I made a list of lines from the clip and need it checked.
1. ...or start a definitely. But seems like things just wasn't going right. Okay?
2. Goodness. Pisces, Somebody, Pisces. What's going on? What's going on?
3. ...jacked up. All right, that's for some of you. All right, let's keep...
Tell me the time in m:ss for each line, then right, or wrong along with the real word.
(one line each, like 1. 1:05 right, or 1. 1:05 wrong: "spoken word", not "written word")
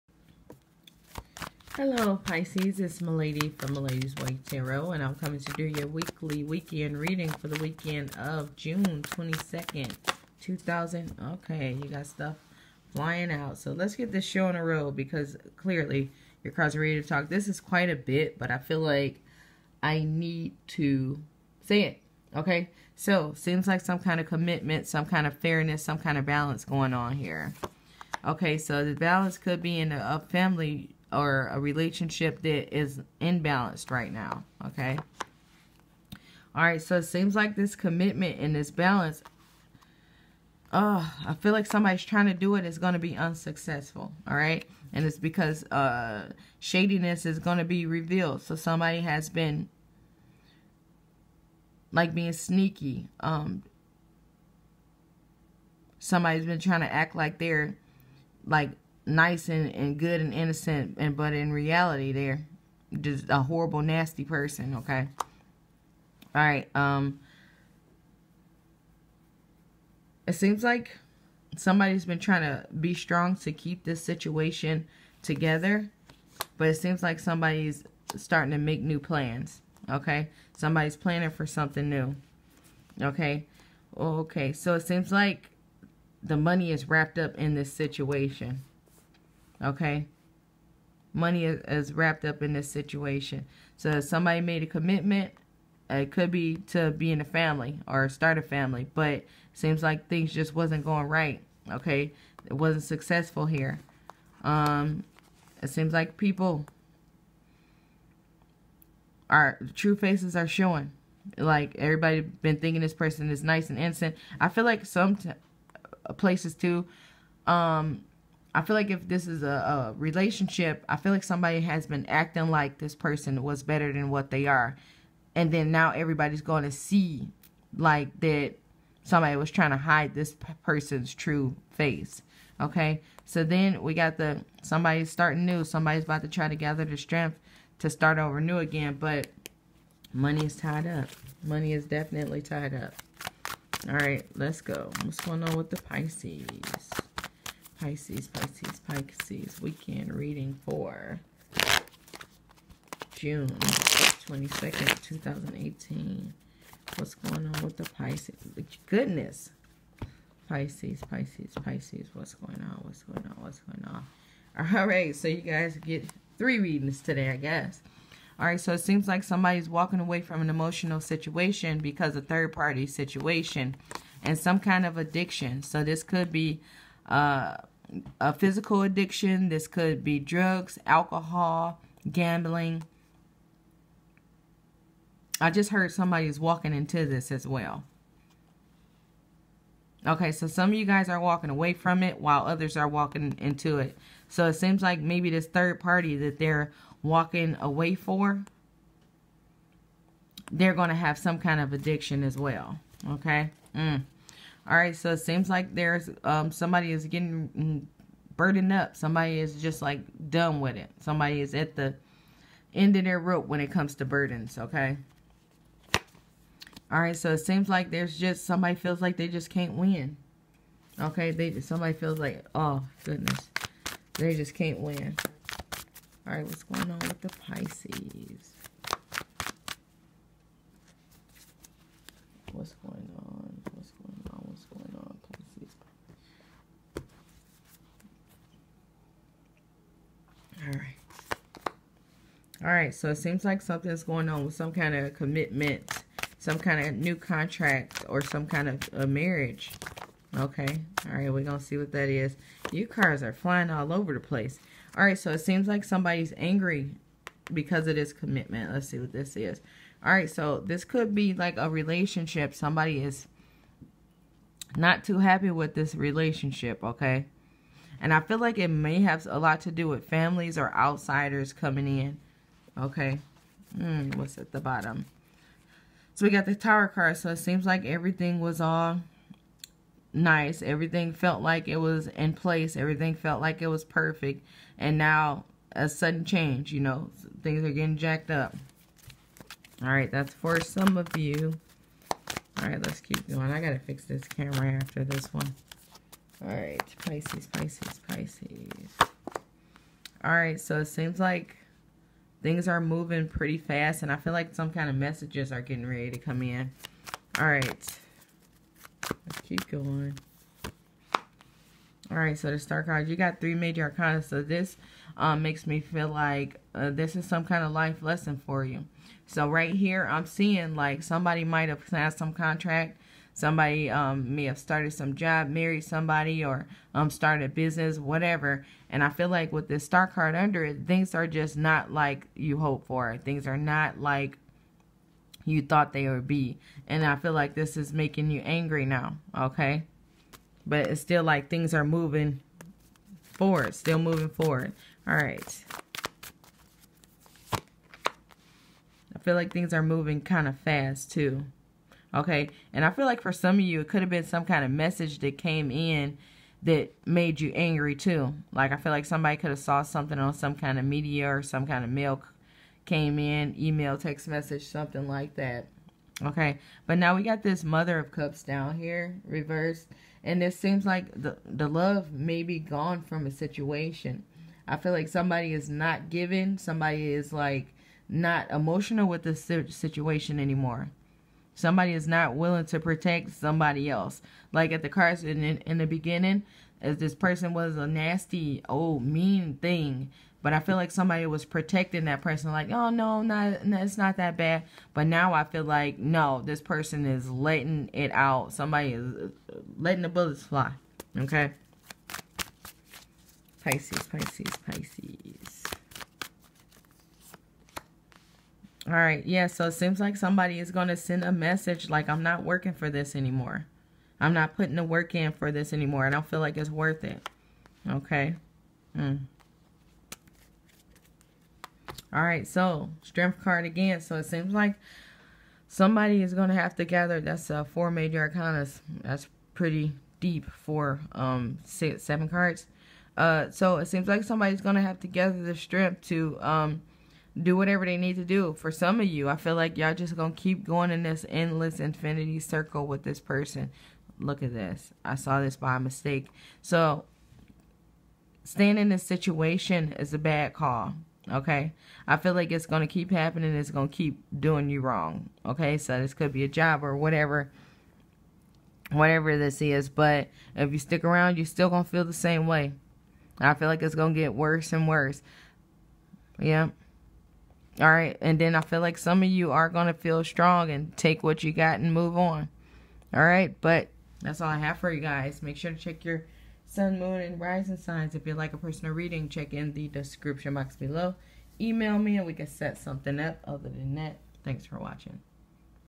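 1. 1:37 wrong: "family", not "definitely"
2. 2:38 wrong: "Pisces", not "Somebody"
3. 4:47 right.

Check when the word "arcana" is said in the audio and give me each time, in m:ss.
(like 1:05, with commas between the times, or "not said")
5:13, 7:08.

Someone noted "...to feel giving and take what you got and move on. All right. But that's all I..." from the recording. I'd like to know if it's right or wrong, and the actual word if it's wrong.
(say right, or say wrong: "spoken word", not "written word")
wrong: "strong", not "giving".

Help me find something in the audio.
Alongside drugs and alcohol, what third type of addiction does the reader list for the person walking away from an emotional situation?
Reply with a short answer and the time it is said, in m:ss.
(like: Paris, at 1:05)
Gambling, at 3:02.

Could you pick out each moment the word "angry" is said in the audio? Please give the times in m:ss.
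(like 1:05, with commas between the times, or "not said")
4:16, 5:38, 5:57.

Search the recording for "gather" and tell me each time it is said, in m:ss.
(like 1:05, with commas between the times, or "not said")
2:16, 7:06, 7:15.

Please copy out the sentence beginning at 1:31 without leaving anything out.
Money is, is wrapped up in this situation.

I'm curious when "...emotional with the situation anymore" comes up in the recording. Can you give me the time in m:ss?
6:18.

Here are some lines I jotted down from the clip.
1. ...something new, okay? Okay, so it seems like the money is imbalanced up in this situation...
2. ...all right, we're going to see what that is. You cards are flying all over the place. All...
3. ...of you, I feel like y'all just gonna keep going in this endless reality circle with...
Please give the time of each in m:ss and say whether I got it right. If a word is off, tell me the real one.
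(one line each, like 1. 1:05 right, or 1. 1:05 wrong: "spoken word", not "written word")
1. 1:21 wrong: "wrapped", not "imbalanced"
2. 4:11 right
3. 7:18 wrong: "infinity", not "reality".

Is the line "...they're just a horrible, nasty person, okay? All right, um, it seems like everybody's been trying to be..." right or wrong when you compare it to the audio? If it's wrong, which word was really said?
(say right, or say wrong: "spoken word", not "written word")
wrong: "somebody", not "everybody".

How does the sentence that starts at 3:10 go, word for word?
Okay, so some of you guys are walking away from it while others are walking into it.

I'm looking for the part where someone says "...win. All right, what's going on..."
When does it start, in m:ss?
3:44.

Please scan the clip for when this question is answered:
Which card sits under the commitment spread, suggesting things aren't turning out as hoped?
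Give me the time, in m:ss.
5:29.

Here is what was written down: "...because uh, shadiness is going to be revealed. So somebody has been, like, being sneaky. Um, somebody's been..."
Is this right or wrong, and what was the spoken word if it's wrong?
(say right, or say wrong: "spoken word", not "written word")
right.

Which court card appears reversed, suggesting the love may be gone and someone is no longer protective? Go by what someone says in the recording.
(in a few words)
Mother of Cups.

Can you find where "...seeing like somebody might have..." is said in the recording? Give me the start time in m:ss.
5:20.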